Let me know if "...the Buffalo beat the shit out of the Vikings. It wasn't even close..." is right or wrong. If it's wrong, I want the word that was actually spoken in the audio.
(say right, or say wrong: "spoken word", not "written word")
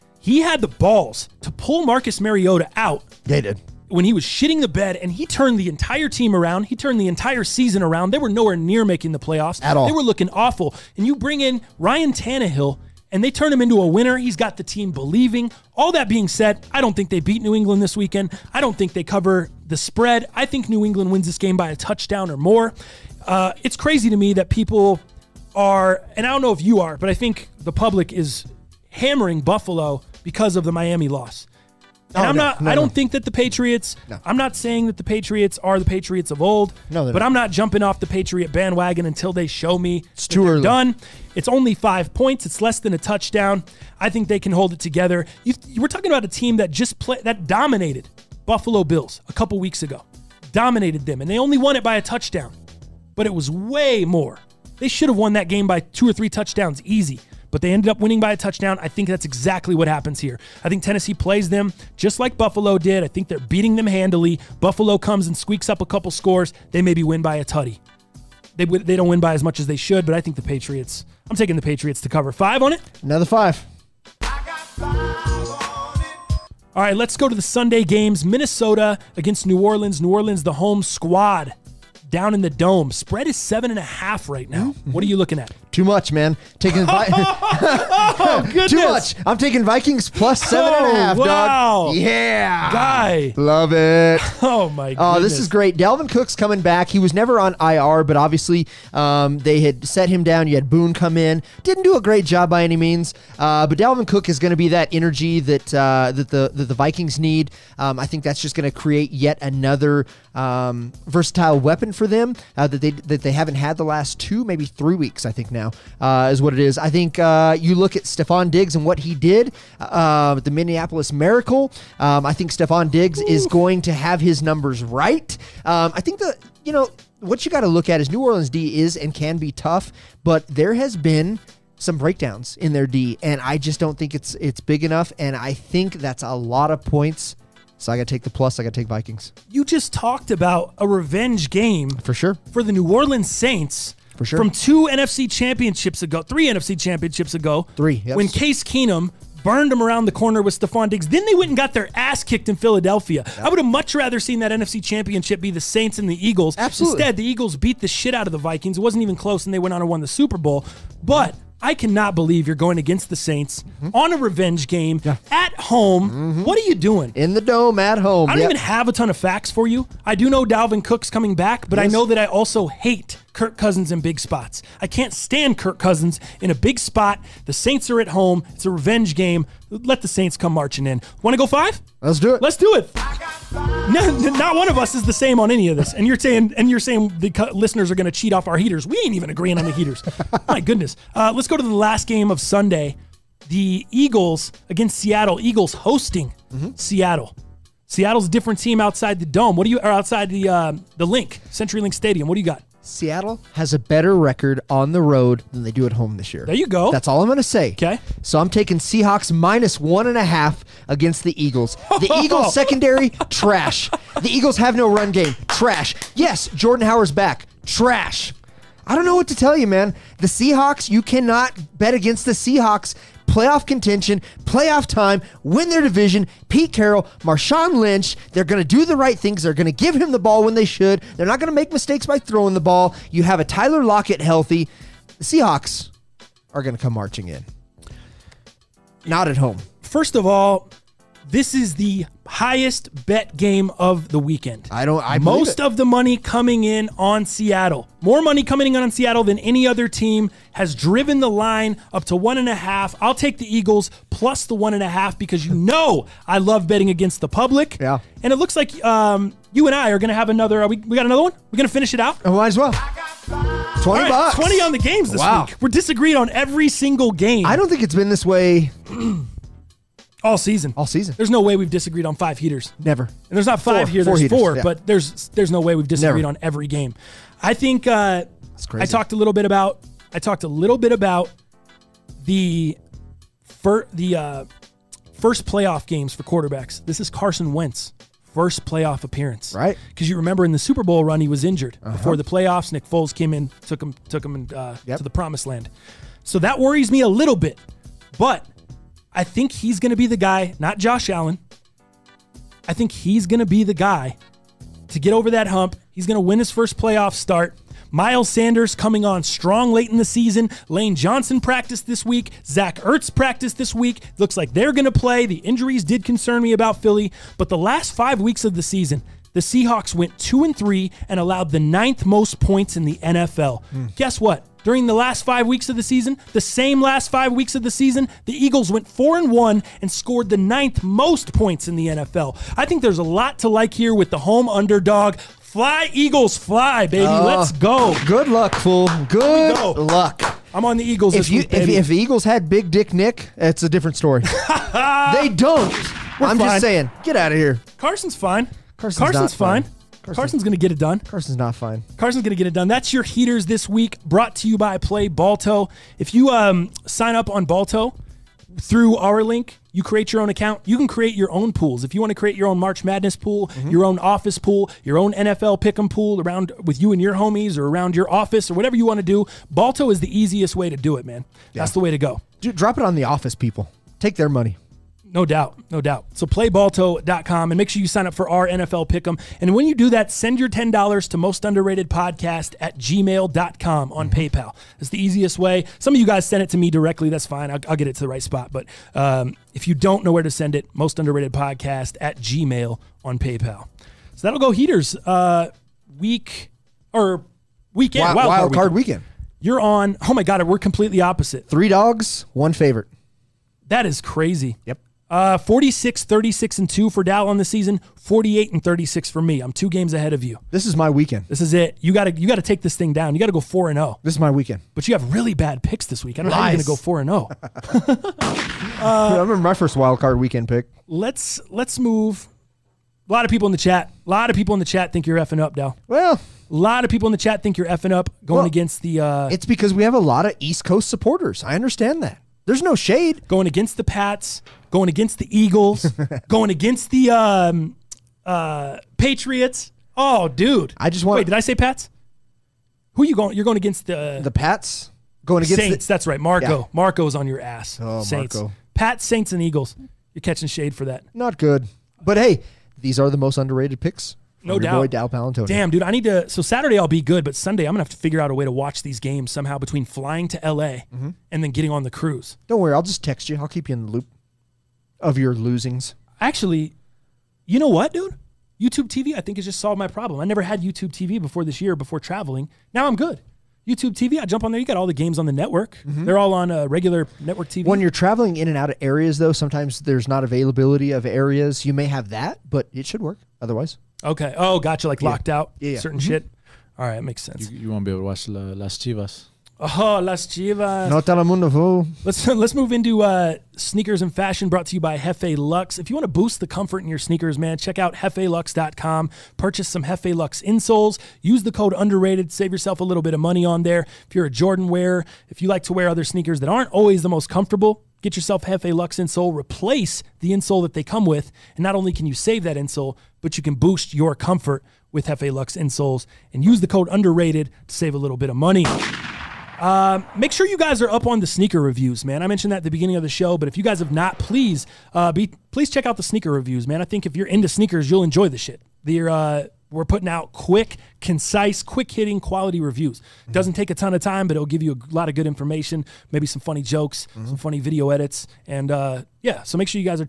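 wrong: "Eagles", not "Buffalo".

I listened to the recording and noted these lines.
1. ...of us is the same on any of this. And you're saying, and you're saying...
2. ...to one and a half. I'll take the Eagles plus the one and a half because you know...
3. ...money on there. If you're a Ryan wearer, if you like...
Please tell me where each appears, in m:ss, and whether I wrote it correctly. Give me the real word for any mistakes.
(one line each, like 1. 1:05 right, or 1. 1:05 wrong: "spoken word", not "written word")
1. 3:04 right
2. 4:12 right
3. 8:23 wrong: "Jordan", not "Ryan".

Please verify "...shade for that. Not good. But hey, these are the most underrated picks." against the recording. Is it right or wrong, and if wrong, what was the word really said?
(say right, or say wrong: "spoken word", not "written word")
right.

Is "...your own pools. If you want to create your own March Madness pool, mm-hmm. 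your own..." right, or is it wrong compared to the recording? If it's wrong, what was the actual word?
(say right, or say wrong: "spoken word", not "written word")
right.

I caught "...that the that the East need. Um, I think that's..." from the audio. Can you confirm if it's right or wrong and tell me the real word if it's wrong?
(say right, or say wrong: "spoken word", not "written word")
wrong: "Vikings", not "East".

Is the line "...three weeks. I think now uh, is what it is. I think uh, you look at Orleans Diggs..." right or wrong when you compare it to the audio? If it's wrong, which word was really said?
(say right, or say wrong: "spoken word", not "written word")
wrong: "Stefon", not "Orleans".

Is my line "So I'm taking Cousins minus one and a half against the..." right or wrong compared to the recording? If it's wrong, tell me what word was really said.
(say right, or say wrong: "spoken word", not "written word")
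wrong: "Seahawks", not "Cousins".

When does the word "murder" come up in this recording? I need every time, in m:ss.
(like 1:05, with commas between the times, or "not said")
not said.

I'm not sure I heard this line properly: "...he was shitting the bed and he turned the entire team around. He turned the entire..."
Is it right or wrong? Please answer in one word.
right.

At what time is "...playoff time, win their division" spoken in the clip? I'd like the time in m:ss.
3:44.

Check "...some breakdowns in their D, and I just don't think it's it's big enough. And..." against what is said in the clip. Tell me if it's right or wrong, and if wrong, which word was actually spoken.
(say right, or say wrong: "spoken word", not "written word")
right.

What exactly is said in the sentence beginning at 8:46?
I think if you're into sneakers, you'll enjoy the shit.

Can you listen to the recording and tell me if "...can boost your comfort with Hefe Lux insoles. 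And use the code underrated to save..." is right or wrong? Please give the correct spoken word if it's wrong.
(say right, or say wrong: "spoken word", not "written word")
right.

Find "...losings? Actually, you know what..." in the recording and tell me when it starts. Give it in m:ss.
7:45.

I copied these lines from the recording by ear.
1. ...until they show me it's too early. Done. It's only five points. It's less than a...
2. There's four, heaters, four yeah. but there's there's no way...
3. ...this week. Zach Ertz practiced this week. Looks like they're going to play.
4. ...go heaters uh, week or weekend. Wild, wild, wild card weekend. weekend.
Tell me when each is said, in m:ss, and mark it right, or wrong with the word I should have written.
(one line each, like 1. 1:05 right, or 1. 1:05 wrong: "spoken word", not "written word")
1. 0:39 right
2. 4:34 right
3. 5:11 right
4. 6:34 right.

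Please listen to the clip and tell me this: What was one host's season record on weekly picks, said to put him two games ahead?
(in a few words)
48-36.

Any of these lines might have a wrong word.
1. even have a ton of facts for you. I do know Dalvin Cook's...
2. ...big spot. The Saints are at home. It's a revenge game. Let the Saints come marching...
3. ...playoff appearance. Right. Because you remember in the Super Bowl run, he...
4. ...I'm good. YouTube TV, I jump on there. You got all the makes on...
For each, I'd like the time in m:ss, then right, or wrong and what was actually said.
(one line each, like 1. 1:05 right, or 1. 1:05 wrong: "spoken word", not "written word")
1. 2:48 right
2. 2:56 right
3. 4:48 right
4. 7:52 wrong: "games", not "makes".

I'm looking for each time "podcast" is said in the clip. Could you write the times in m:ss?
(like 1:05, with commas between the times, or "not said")
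6:21, 6:31.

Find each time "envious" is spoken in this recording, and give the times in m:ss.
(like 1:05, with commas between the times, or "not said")
not said.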